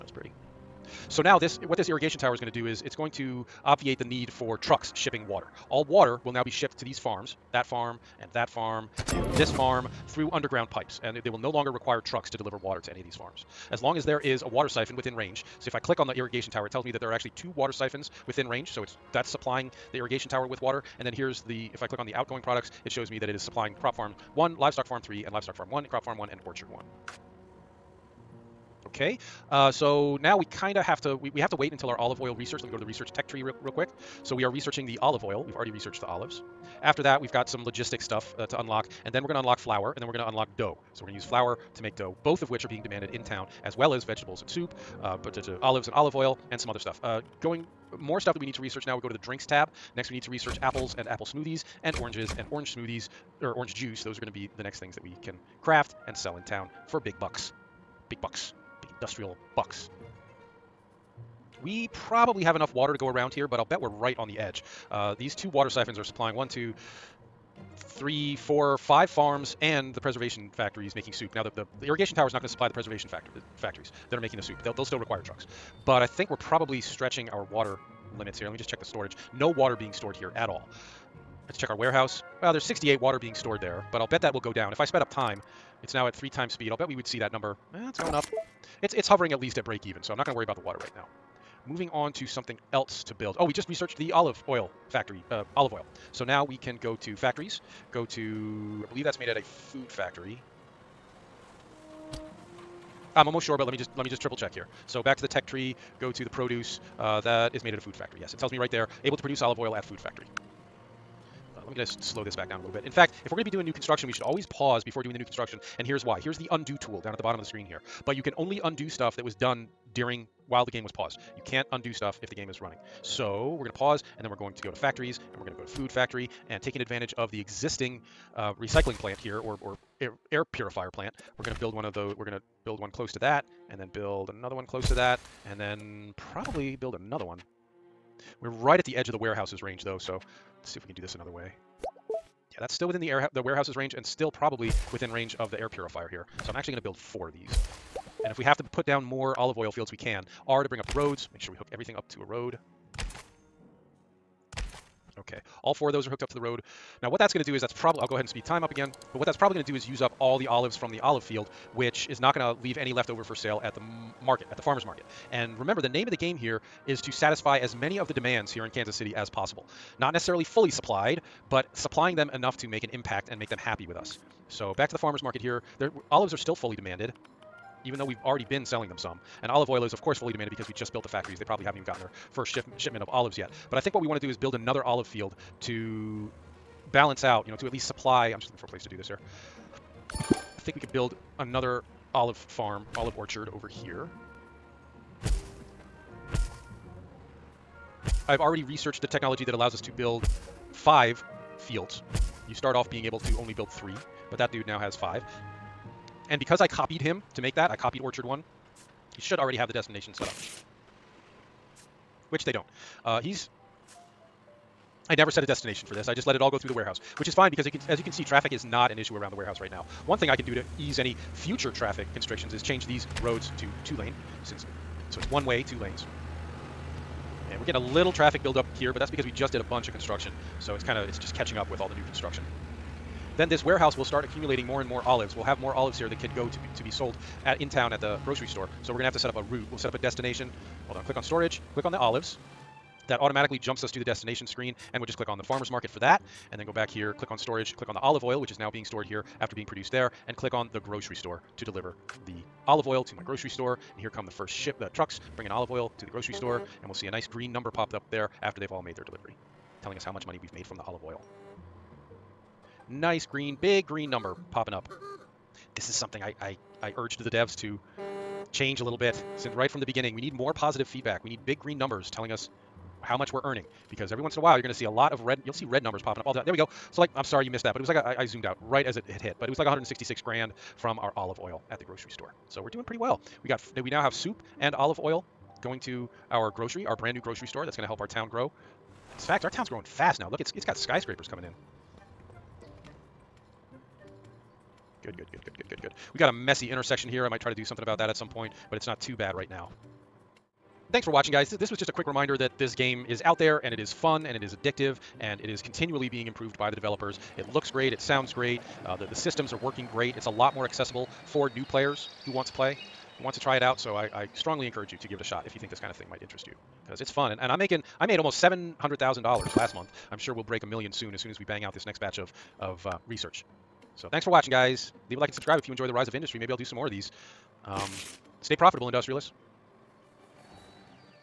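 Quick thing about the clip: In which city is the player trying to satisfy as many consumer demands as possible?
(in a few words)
Kansas City.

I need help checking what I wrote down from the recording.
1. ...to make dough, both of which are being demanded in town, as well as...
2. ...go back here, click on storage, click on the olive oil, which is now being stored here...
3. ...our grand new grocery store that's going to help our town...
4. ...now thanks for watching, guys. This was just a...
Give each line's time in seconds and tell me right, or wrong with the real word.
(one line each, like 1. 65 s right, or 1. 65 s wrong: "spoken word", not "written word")
1. 41 s right
2. 246 s right
3. 286 s wrong: "brand", not "grand"
4. 299 s right.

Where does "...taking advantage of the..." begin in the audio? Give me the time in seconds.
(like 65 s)
126 s.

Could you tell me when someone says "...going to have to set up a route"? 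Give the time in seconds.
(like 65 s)
238 s.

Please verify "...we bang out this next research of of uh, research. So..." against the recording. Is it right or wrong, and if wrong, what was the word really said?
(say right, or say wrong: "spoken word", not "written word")
wrong: "batch", not "research".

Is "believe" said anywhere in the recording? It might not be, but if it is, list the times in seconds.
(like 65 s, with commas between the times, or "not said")
98 s.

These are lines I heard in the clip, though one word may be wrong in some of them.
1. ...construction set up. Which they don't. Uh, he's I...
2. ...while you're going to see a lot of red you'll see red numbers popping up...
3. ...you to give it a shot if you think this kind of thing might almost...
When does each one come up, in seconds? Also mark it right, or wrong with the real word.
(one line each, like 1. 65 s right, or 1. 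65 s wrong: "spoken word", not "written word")
1. 209 s wrong: "destination", not "construction"
2. 274 s right
3. 314 s wrong: "interest", not "almost".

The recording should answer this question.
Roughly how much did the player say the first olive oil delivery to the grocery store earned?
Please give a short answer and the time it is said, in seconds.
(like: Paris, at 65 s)
166 grand, at 279 s.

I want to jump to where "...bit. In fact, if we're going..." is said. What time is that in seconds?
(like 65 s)
112 s.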